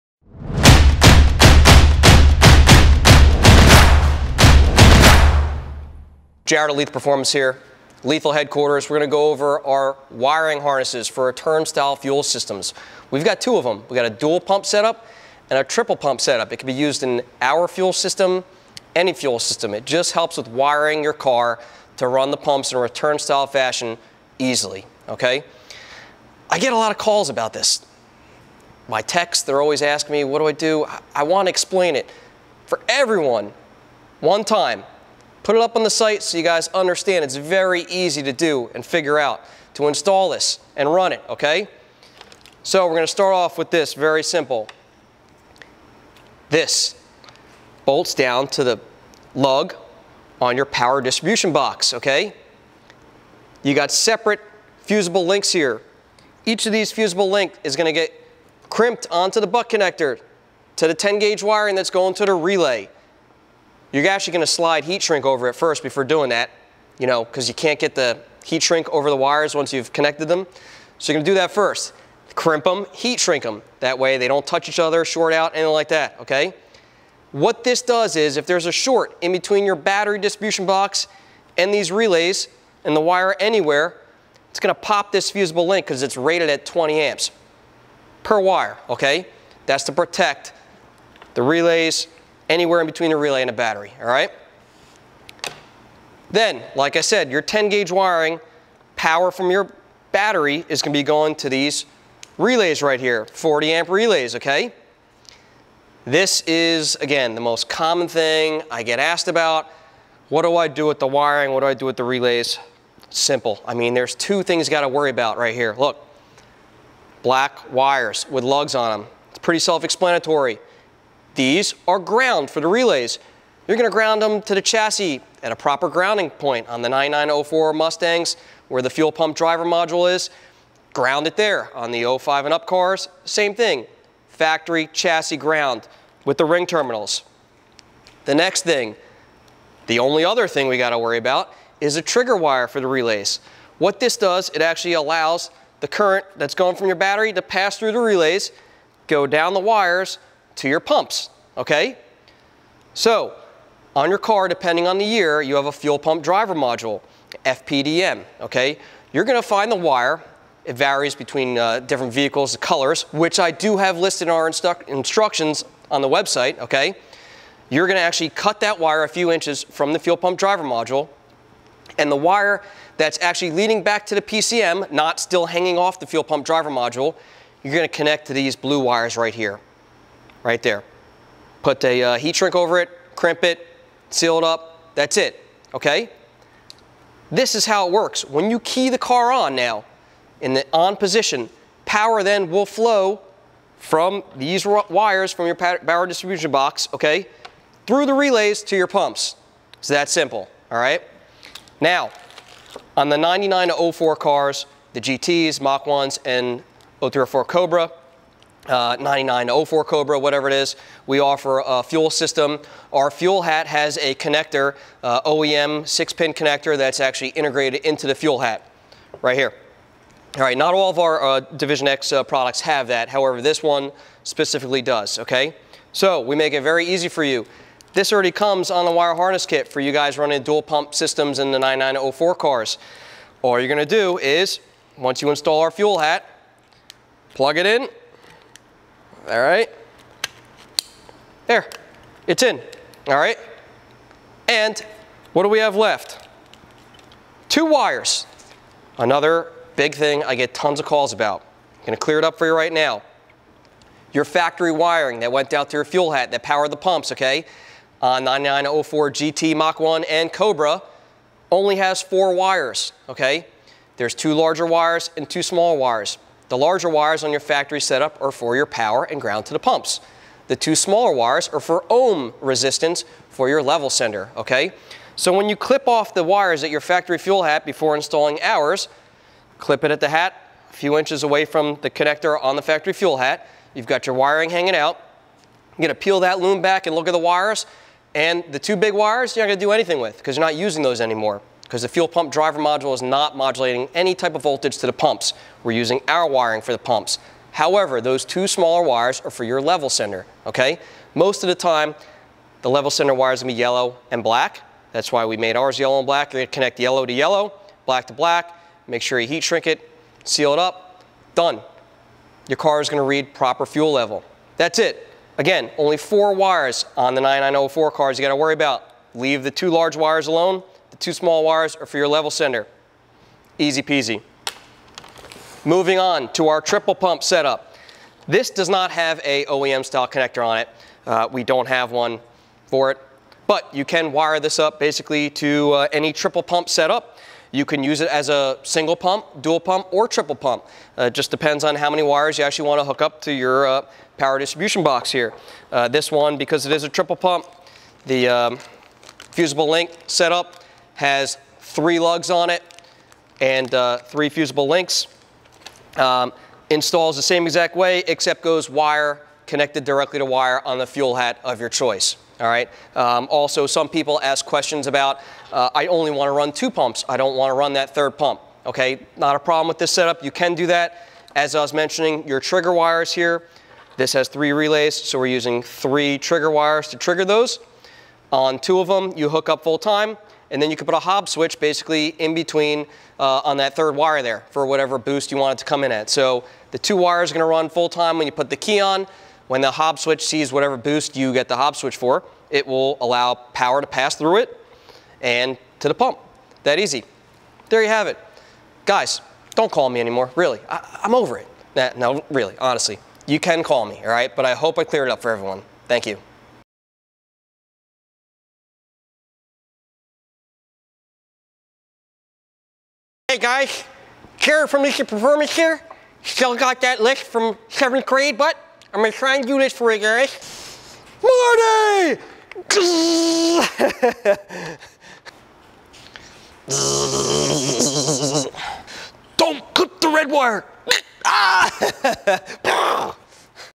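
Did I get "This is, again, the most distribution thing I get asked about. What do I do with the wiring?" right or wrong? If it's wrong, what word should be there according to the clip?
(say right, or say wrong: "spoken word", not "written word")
wrong: "common", not "distribution".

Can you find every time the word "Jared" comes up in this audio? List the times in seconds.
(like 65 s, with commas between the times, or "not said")
6 s, 414 s.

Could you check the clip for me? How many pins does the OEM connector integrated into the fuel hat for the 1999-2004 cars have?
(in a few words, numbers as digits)
6.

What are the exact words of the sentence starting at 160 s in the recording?
It varies between uh, different vehicles, the colors, which I do have listed in our instru instructions on the website, okay?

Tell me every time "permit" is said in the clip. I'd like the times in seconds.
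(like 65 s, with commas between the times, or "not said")
not said.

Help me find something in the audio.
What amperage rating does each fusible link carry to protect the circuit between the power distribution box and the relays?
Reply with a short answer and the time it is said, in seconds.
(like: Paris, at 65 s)
20 amps, at 86 s.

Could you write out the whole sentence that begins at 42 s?
So we're gonna start off with this, very simple.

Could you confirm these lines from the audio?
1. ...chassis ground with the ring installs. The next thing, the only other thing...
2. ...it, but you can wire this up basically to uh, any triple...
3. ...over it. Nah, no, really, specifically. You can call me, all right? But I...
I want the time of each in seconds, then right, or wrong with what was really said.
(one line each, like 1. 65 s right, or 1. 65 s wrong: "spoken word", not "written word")
1. 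134 s wrong: "terminals", not "installs"
2. 332 s right
3. 401 s wrong: "honestly", not "specifically".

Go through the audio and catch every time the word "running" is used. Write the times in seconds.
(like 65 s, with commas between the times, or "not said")
230 s.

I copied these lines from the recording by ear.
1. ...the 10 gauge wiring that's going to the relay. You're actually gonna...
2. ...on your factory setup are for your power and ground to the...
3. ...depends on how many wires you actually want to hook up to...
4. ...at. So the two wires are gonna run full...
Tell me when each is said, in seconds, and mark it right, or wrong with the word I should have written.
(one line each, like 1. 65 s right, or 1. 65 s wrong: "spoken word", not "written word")
1. 60 s right
2. 267 s right
3. 341 s right
4. 385 s right.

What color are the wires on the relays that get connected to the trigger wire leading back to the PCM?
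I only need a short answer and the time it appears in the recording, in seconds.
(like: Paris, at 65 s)
blue, at 178 s.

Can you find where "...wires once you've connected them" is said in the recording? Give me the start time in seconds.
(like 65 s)
69 s.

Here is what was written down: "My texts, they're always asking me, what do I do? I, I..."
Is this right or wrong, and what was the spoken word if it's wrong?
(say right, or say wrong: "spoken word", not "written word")
right.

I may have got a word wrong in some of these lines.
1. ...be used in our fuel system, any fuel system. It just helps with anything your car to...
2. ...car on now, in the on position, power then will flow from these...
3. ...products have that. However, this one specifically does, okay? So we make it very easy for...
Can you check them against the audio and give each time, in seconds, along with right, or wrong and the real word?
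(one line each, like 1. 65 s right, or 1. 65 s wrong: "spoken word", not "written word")
1. 16 s wrong: "wiring", not "anything"
2. 188 s right
3. 222 s right.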